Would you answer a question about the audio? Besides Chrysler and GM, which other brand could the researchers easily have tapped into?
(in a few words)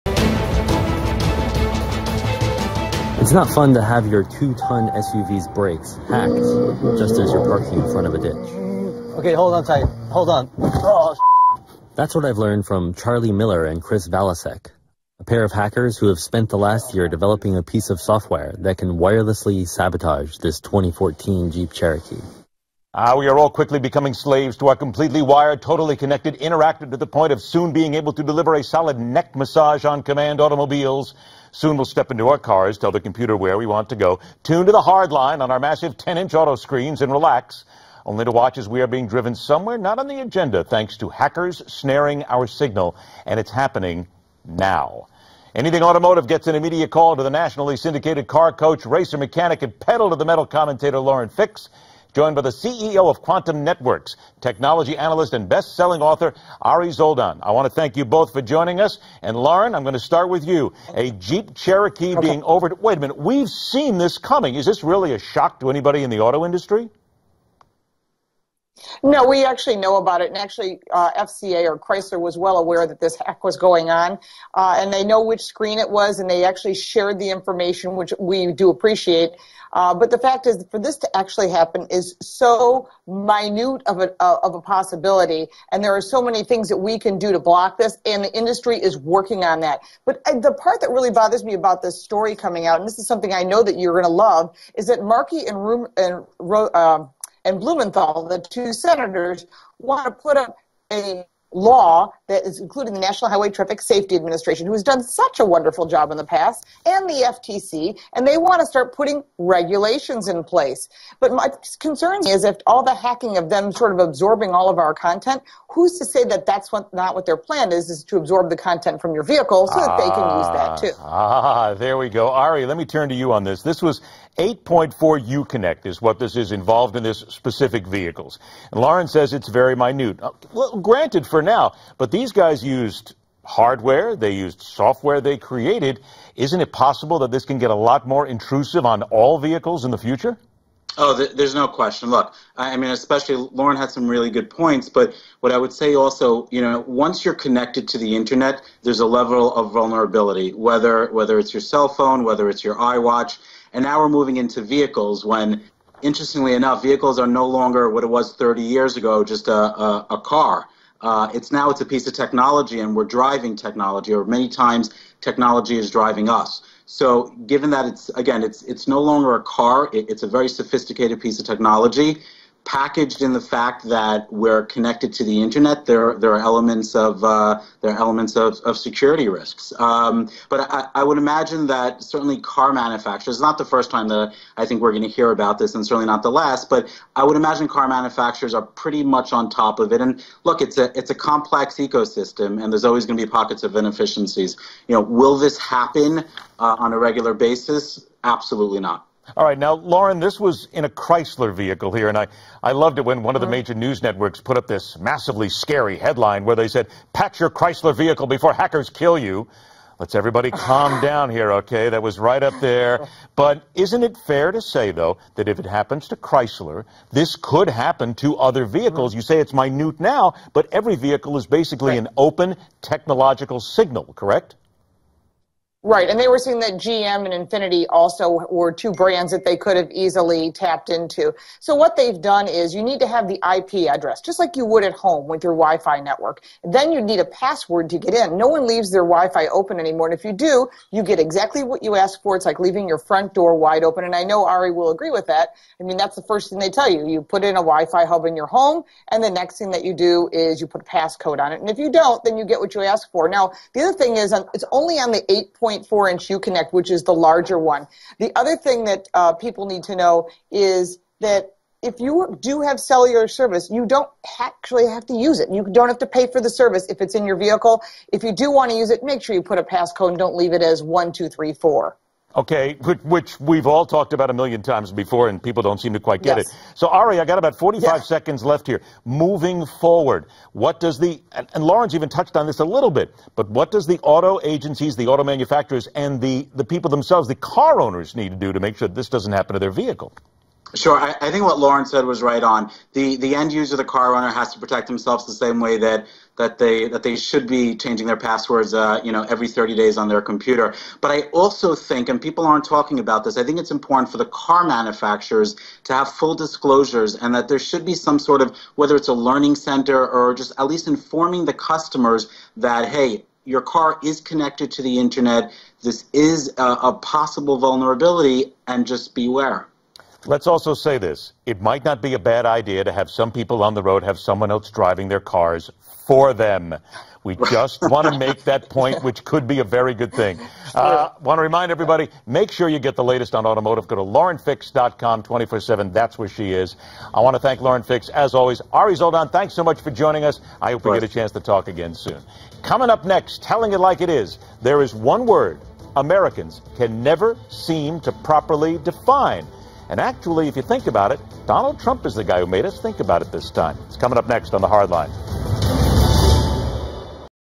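Infiniti.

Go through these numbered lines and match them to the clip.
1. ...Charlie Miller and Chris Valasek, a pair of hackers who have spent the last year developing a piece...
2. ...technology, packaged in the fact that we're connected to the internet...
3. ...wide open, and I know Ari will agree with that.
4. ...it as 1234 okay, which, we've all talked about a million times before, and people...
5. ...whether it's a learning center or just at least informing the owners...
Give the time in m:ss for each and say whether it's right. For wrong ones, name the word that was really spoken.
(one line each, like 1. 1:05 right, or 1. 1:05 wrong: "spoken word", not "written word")
1. 0:12 right
2. 2:51 right
3. 4:03 right
4. 4:30 right
5. 5:08 wrong: "customers", not "owners".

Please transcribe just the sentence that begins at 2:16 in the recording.
Isn't it possible that this can get a lot more intrusive on all vehicles in the future?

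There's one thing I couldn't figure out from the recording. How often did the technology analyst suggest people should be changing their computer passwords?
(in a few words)
every 30 days.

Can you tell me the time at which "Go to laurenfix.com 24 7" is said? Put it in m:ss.
5:33.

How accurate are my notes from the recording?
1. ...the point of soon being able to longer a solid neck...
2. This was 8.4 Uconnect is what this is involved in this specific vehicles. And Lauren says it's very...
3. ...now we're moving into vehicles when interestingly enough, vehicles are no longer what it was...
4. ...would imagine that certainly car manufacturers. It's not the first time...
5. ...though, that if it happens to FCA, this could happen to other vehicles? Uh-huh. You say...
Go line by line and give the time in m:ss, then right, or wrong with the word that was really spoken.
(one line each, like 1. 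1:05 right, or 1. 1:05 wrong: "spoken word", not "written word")
1. 0:26 wrong: "deliver", not "longer"
2. 2:03 right
3. 2:33 right
4. 3:01 right
5. 3:34 wrong: "Chrysler", not "FCA".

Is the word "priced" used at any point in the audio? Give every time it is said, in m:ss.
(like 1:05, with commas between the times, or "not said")
not said.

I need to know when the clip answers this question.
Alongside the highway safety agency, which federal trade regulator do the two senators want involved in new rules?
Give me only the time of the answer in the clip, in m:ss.
1:47.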